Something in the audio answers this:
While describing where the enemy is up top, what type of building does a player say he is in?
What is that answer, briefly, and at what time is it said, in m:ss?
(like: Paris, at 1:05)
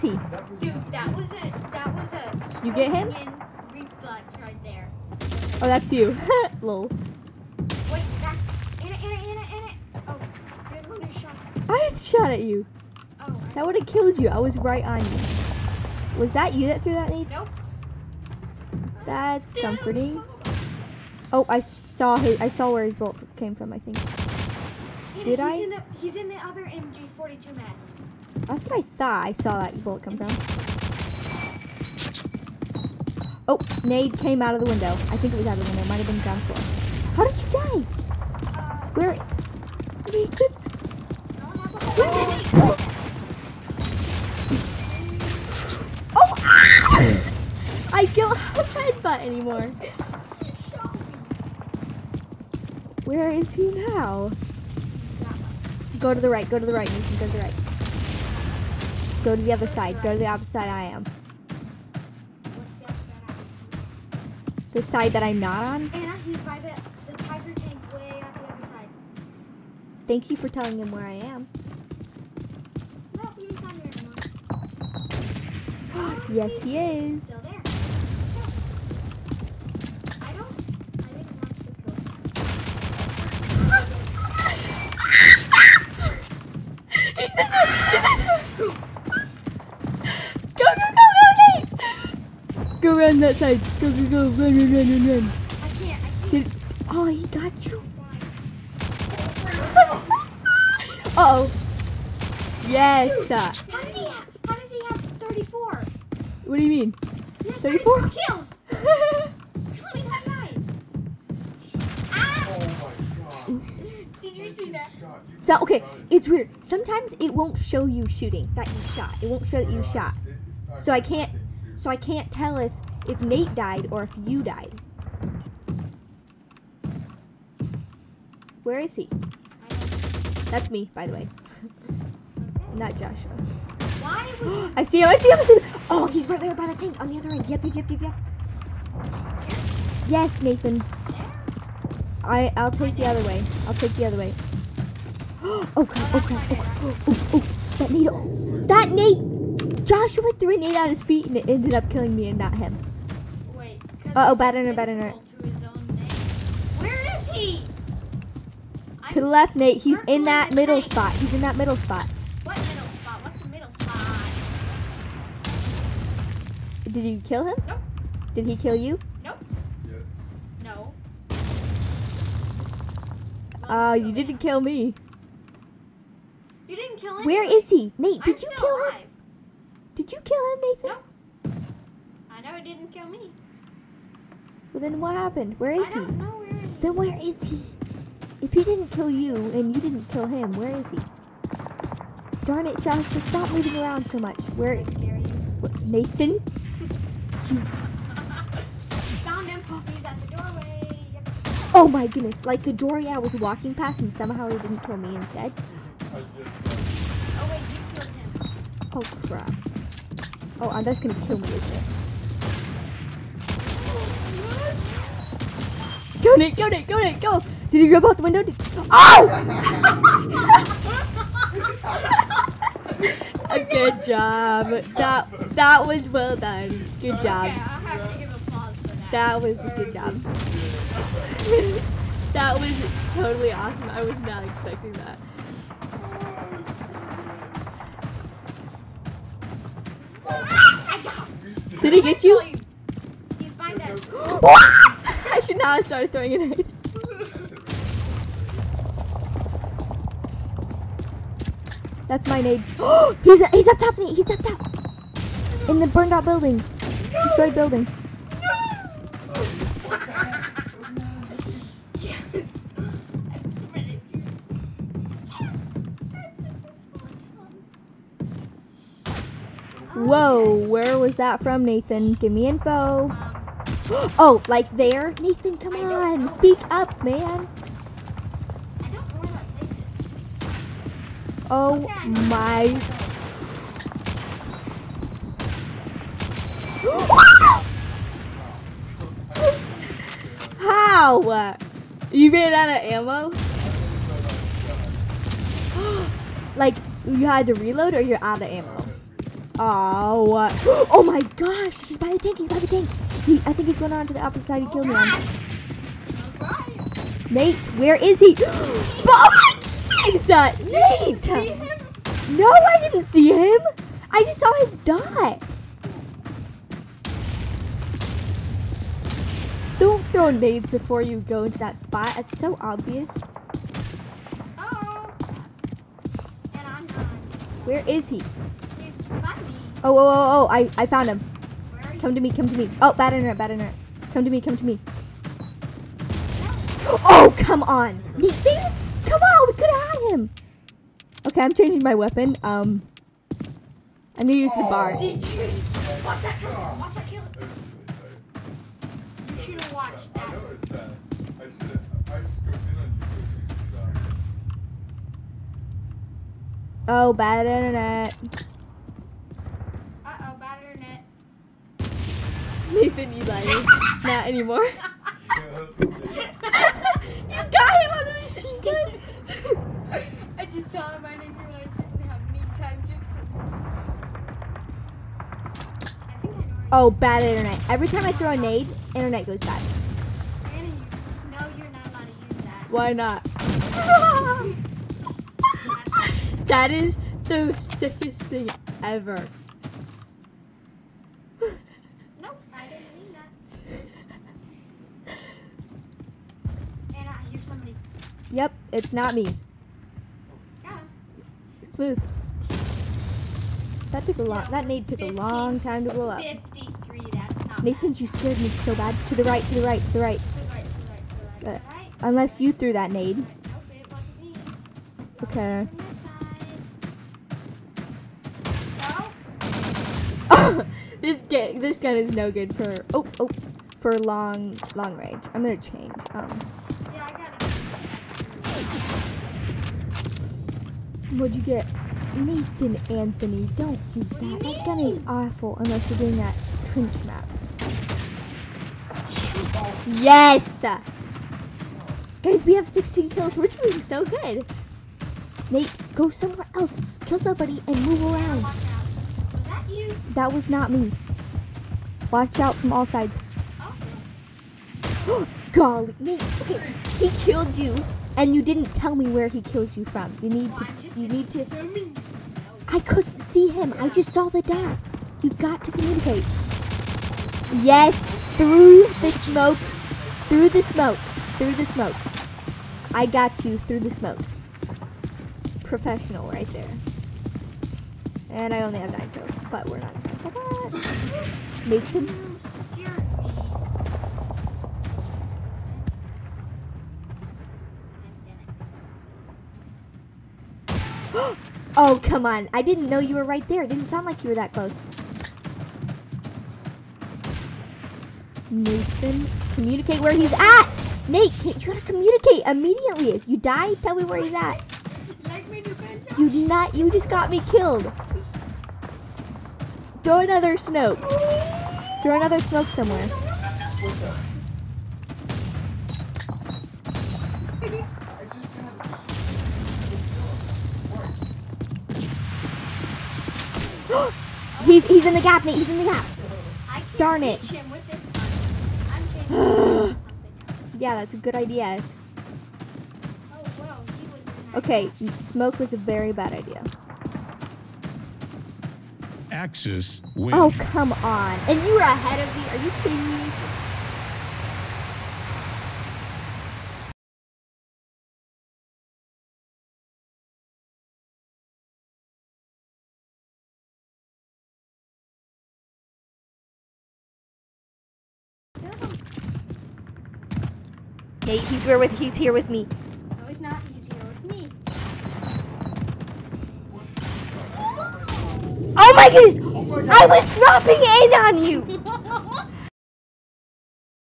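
burned out building, at 4:15.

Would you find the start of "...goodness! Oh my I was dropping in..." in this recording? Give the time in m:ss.
9:29.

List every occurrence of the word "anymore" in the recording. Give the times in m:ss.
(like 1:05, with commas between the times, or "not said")
0:49, 6:04.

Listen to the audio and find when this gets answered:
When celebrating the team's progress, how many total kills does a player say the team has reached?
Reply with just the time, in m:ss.
7:22.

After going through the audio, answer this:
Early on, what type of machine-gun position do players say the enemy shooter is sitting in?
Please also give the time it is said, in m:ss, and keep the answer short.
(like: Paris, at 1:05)
MG42, at 0:26.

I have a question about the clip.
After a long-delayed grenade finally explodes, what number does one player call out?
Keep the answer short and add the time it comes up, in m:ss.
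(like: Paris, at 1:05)
53, at 6:46.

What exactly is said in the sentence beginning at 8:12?
I didn't know you were right there.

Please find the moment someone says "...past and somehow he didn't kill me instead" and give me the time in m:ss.
3:23.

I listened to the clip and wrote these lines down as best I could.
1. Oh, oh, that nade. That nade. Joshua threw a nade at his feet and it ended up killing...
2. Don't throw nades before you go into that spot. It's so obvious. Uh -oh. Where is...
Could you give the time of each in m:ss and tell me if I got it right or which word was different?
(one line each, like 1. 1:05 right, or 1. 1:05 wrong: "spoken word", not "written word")
1. 2:26 right
2. 5:19 right.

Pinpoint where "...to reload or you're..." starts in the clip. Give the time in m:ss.
4:57.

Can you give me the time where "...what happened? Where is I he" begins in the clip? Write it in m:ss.
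3:05.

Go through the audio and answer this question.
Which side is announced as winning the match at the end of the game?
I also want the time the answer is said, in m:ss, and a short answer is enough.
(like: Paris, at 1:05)
Axis, at 8:59.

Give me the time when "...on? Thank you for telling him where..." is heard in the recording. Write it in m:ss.
1:05.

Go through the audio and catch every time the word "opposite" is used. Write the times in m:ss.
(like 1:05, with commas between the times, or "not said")
1:00, 5:04.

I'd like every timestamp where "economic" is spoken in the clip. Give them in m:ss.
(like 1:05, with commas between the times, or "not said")
not said.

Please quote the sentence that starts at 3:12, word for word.
Darn it, Josh, just stop moving around so much.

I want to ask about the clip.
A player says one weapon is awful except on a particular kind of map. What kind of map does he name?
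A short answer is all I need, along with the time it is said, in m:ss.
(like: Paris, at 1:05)
trench map, at 7:16.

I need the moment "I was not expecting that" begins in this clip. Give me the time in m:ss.
3:53.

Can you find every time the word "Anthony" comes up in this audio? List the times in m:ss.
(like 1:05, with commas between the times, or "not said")
7:12.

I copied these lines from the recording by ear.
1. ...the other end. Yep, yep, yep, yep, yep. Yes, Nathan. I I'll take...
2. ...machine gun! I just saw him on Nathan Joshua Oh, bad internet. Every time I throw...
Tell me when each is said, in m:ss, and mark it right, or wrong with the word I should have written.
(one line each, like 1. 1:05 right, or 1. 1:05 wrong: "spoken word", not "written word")
1. 2:17 right
2. 6:08 wrong: "Eli", not "Joshua".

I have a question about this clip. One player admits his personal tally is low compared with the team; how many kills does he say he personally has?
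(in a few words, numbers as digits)
9.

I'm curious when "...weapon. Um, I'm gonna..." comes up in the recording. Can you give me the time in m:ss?
5:41.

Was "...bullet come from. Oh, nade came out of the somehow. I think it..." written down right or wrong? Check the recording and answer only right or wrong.
wrong.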